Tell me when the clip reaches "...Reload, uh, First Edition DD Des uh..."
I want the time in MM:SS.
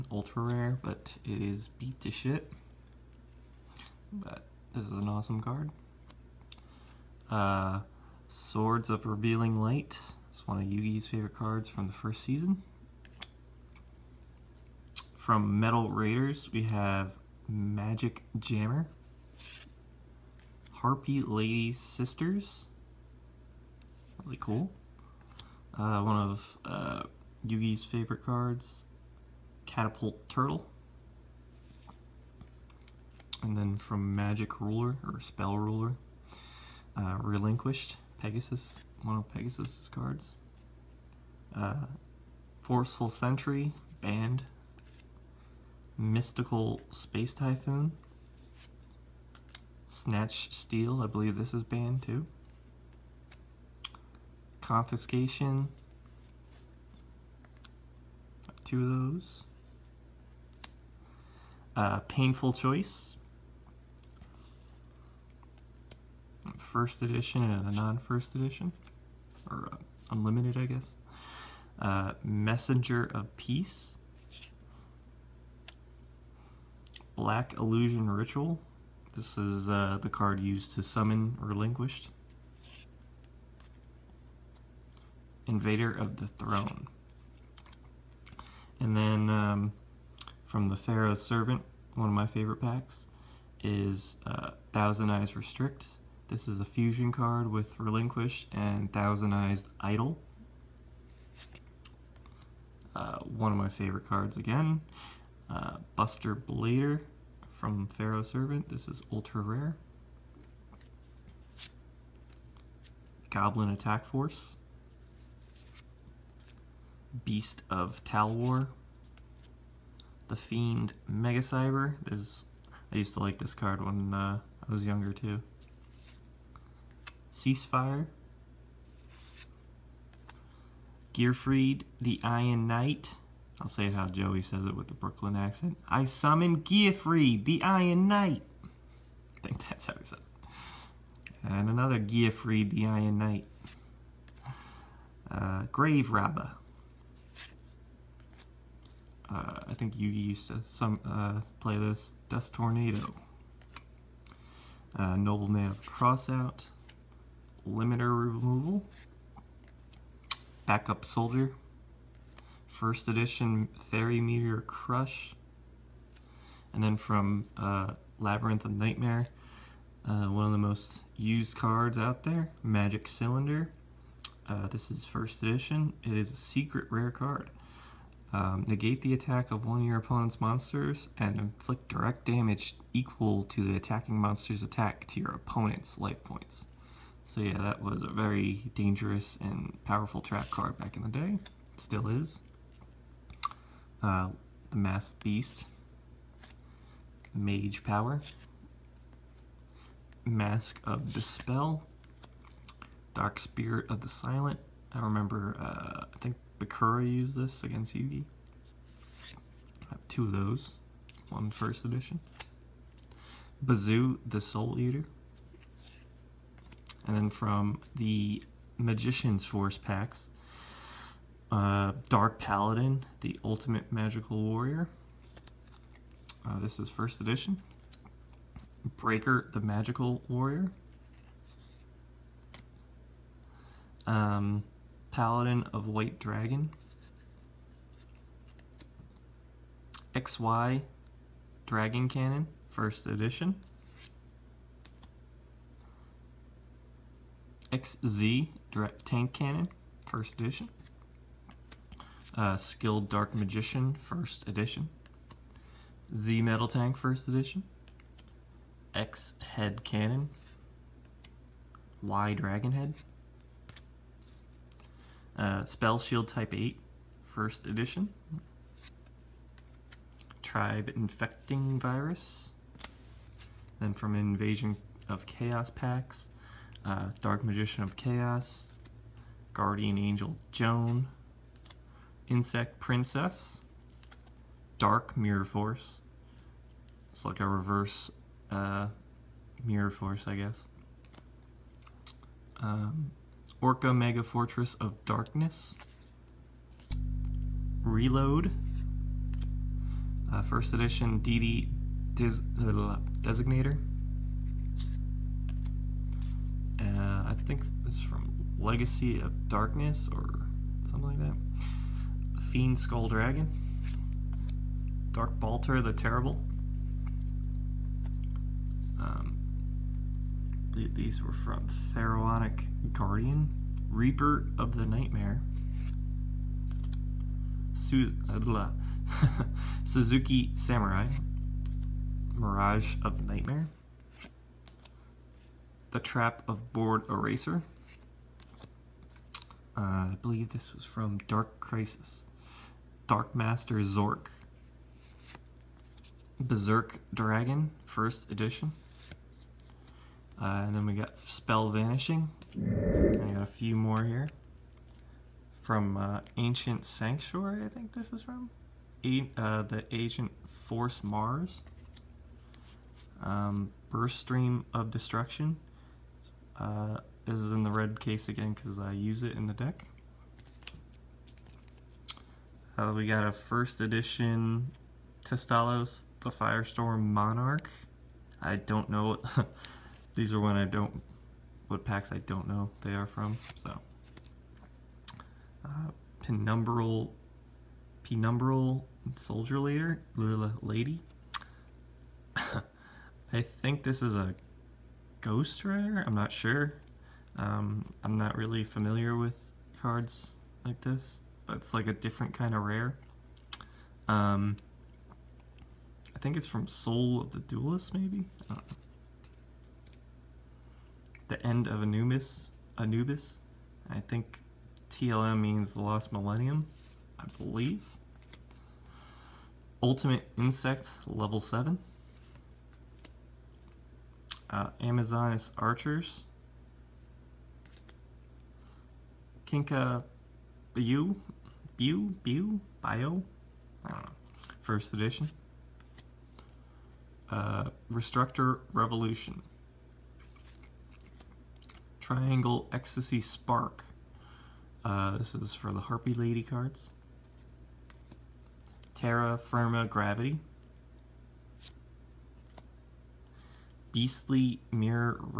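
04:57.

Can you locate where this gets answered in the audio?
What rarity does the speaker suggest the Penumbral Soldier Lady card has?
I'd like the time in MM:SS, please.
06:35.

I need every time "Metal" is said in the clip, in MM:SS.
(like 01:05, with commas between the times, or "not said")
00:15, 04:16.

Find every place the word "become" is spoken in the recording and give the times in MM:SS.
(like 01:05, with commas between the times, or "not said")
not said.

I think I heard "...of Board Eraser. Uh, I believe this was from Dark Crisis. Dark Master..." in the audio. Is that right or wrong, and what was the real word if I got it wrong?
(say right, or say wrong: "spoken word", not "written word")
right.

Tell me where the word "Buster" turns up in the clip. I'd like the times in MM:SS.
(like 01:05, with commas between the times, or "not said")
01:45.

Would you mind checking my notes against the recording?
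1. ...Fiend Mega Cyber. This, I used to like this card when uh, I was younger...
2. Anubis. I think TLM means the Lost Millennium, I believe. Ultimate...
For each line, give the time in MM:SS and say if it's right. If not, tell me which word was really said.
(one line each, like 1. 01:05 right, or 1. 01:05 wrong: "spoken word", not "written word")
1. 02:00 right
2. 06:52 right.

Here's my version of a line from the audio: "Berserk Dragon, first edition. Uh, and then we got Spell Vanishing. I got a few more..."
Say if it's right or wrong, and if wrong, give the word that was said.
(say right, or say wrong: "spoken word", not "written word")
right.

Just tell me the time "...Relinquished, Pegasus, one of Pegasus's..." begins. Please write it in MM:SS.
00:37.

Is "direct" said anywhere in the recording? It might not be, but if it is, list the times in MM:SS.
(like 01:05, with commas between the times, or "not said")
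03:01, 04:08.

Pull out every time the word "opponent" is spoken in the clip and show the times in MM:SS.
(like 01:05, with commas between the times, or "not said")
02:59, 03:05.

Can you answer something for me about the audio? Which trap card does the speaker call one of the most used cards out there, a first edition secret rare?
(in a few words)
Magic Cylinder.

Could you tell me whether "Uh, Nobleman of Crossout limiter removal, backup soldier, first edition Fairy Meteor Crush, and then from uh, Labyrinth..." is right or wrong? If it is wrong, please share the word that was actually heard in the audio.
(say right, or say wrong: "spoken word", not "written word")
right.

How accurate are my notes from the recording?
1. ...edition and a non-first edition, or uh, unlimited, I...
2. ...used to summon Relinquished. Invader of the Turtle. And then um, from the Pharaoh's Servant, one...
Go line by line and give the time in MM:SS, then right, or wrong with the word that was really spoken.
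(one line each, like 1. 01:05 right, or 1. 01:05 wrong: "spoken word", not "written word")
1. 01:07 right
2. 01:20 wrong: "Throne", not "Turtle".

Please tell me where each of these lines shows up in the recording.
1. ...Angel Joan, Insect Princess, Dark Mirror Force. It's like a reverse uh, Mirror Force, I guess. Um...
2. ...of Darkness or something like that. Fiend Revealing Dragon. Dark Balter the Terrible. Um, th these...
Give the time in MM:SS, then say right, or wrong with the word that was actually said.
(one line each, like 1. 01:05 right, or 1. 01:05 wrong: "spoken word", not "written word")
1. 04:39 right
2. 05:09 wrong: "Skull", not "Revealing".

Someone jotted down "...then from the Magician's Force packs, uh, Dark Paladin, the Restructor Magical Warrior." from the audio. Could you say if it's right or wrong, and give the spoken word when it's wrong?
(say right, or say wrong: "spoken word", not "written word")
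wrong: "Ultimate", not "Restructor".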